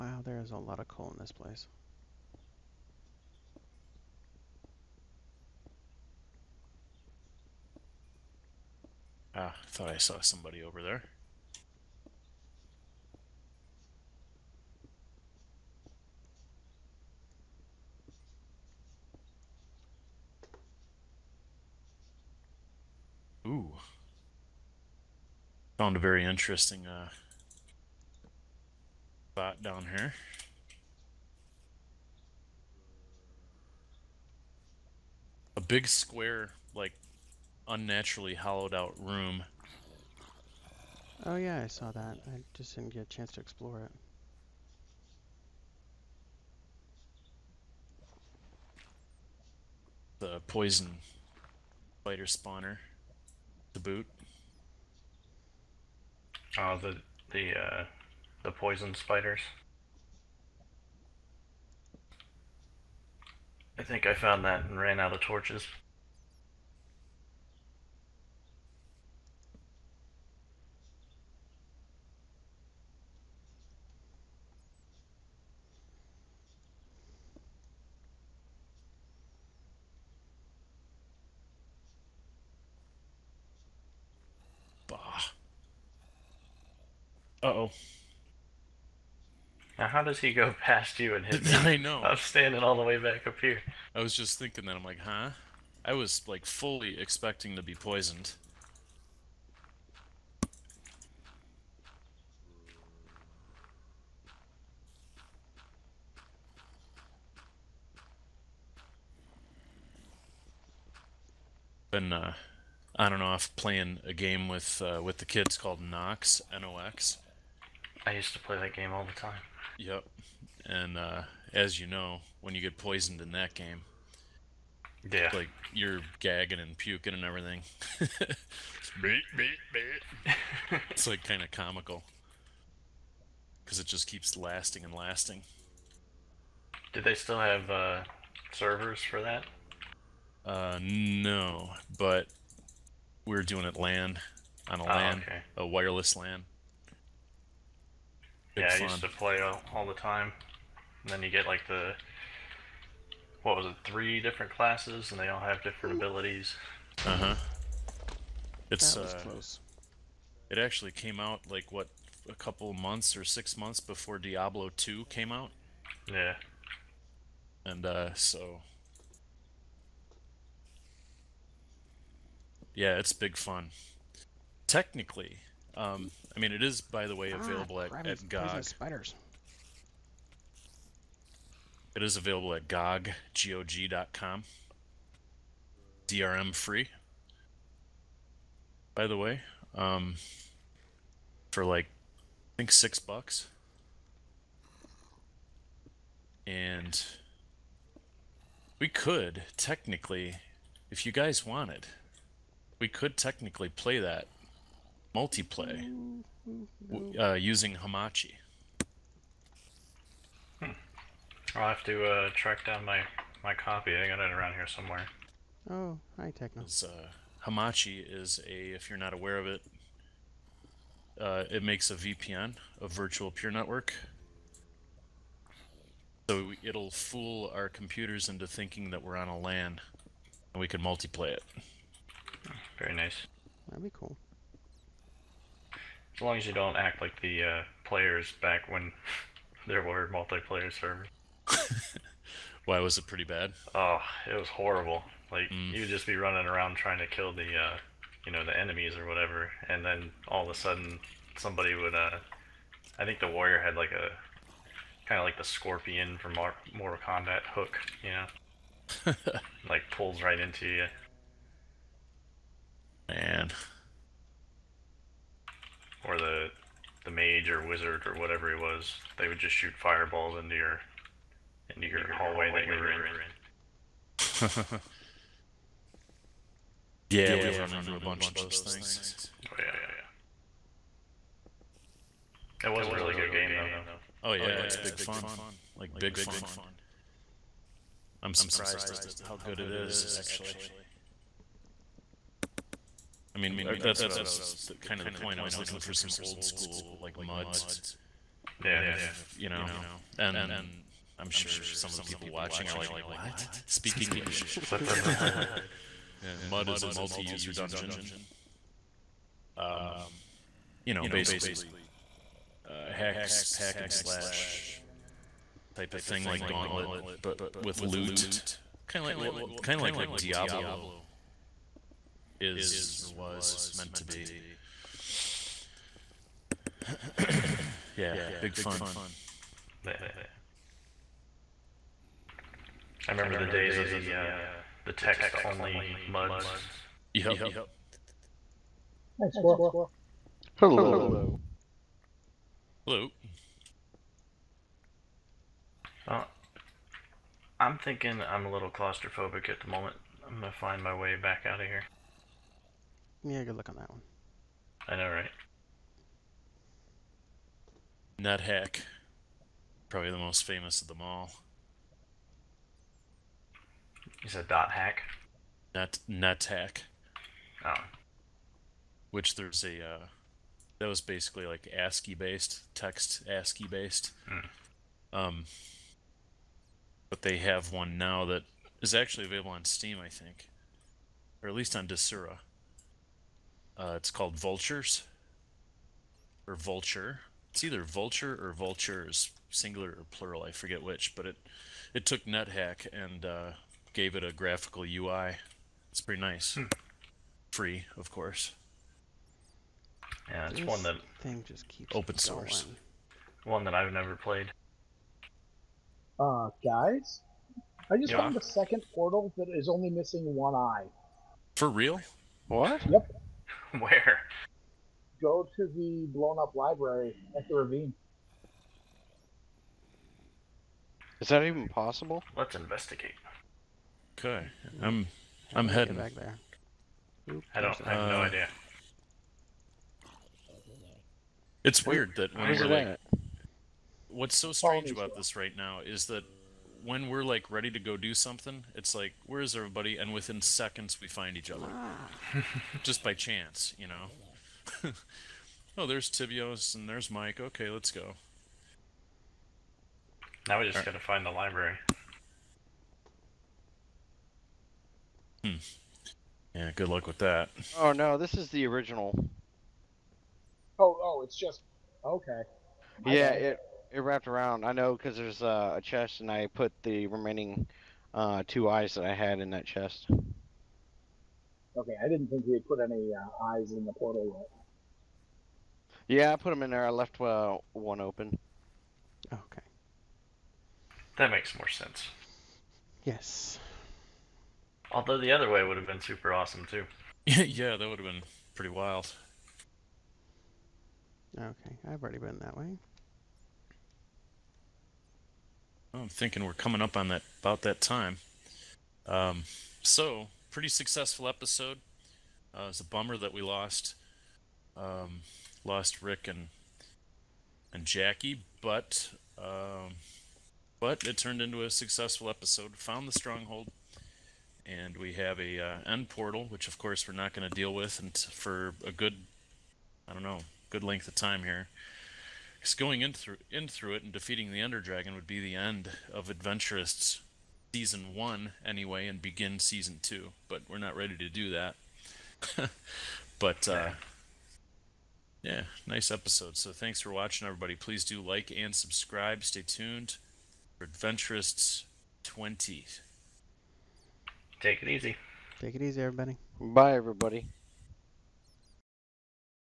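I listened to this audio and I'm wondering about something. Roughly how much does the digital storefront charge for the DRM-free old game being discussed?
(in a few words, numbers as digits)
6 bucks.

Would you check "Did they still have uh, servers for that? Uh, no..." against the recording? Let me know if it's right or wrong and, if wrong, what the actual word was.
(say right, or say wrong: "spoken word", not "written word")
right.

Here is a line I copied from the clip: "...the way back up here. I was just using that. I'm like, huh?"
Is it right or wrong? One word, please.
wrong.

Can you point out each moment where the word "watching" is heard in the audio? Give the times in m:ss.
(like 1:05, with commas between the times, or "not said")
5:02, 8:57.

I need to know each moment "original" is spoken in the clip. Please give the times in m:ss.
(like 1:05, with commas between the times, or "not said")
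7:38.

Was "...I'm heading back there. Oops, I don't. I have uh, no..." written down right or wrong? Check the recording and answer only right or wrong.
right.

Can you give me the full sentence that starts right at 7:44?
I know because there's uh, a chest, and I put the remaining uh, two eyes that I had in that chest.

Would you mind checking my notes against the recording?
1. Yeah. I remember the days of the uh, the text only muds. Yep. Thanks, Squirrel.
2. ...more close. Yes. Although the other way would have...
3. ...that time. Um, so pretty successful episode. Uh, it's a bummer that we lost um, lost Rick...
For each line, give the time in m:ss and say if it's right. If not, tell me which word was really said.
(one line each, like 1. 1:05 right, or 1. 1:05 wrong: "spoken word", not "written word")
1. 5:29 right
2. 8:01 wrong: "sense", not "close"
3. 8:17 right.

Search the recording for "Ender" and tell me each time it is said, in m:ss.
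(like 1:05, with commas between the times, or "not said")
8:44.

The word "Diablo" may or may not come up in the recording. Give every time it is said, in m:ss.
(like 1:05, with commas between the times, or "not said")
2:44, 5:20.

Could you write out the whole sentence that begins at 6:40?
Yeah, it's this one that thing just keeps open source.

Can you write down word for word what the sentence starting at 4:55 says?
I was looking for some old school like muds.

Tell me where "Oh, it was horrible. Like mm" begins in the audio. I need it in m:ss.
4:03.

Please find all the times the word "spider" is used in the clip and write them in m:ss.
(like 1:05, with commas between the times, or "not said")
0:52, 0:58, 2:58.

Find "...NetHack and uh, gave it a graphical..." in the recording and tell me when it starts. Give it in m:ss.
6:32.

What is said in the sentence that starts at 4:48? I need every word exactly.
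I'm surprised at how good it is actually.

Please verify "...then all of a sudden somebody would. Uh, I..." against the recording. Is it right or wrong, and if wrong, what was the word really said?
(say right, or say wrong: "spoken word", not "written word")
right.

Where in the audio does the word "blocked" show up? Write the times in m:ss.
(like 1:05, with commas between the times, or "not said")
not said.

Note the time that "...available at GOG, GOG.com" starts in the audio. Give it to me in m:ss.
3:02.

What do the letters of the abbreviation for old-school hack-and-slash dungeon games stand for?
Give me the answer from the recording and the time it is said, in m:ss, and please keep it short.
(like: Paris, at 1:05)
multi-user dungeon, at 5:06.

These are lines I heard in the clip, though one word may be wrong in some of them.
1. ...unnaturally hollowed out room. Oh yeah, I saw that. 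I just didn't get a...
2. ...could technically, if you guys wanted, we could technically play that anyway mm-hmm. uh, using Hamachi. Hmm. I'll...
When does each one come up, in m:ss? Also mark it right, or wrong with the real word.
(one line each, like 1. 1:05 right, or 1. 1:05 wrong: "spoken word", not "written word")
1. 0:37 right
2. 3:18 wrong: "multiplay", not "anyway".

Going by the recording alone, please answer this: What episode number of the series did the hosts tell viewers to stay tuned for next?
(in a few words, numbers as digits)
20.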